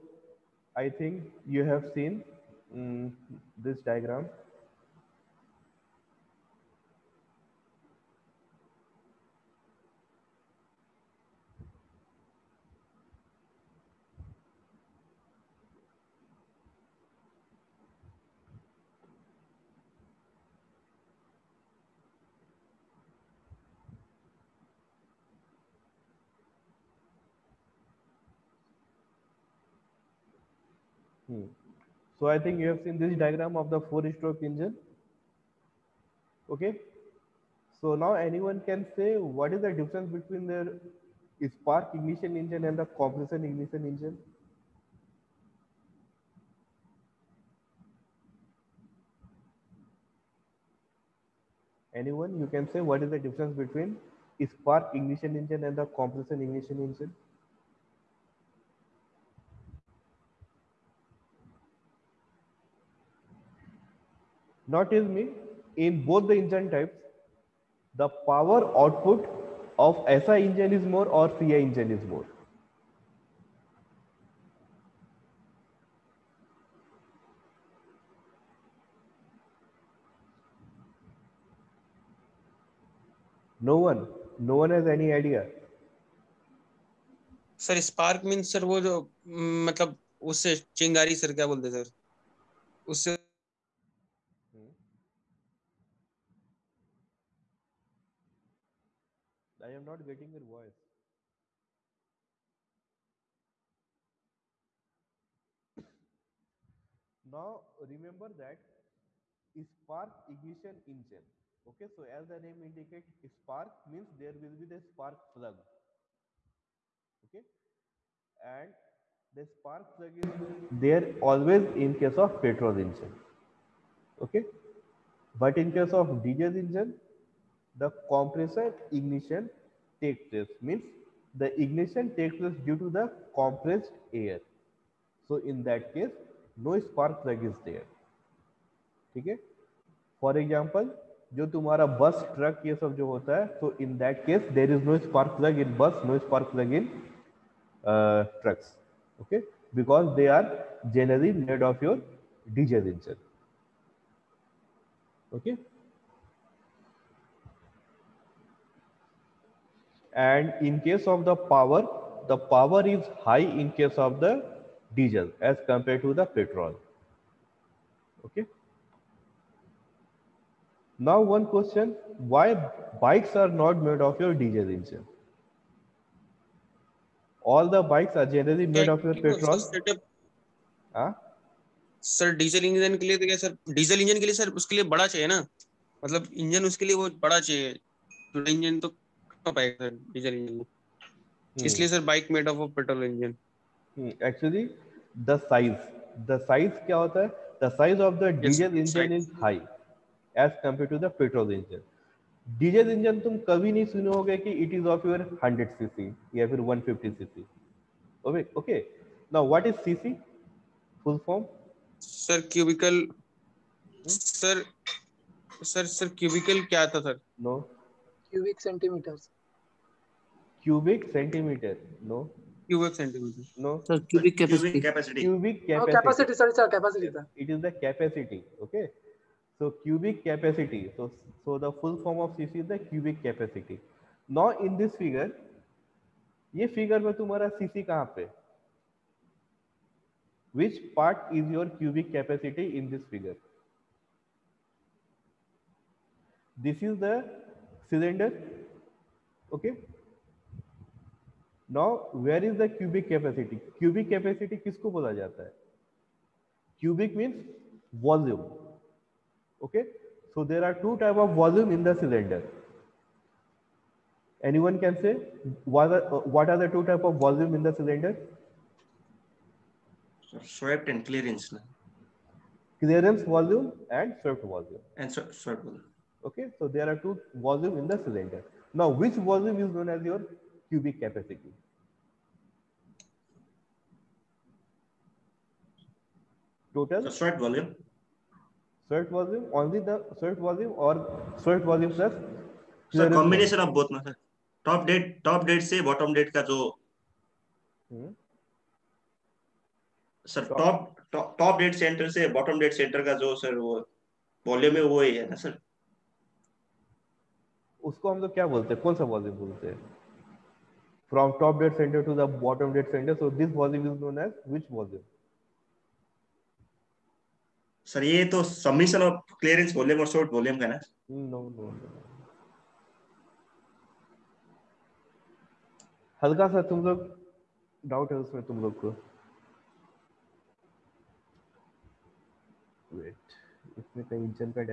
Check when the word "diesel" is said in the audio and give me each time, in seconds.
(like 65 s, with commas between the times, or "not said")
126 s, 164 s, 174 s.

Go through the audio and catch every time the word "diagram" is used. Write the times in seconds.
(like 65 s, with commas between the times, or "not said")
3 s, 33 s.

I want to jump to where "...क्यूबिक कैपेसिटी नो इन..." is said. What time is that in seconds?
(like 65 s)
232 s.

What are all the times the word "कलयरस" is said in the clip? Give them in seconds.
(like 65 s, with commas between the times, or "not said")
319 s.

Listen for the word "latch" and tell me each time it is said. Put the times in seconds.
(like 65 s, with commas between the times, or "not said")
not said.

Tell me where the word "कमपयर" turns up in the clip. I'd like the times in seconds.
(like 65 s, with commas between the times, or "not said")
200 s.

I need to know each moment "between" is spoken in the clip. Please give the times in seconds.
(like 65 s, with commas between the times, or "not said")
40 s, 53 s.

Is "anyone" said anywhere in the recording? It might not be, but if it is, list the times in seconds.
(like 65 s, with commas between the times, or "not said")
38 s, 51 s, 264 s.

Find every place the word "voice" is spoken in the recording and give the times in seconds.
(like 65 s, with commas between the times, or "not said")
100 s.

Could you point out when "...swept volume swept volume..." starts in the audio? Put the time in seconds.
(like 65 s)
287 s.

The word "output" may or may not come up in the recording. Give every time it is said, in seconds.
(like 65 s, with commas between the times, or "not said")
68 s.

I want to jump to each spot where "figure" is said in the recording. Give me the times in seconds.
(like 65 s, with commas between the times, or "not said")
243 s.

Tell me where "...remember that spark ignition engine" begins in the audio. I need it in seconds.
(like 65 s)
107 s.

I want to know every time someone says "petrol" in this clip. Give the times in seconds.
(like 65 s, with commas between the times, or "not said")
122 s, 166 s, 179 s.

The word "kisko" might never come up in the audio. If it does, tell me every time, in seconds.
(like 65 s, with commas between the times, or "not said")
254 s.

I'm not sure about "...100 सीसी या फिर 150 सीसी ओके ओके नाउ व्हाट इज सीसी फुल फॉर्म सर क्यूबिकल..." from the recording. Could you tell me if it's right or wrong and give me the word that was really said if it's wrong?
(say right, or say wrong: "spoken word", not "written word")
right.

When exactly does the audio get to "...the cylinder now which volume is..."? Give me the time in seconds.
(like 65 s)
277 s.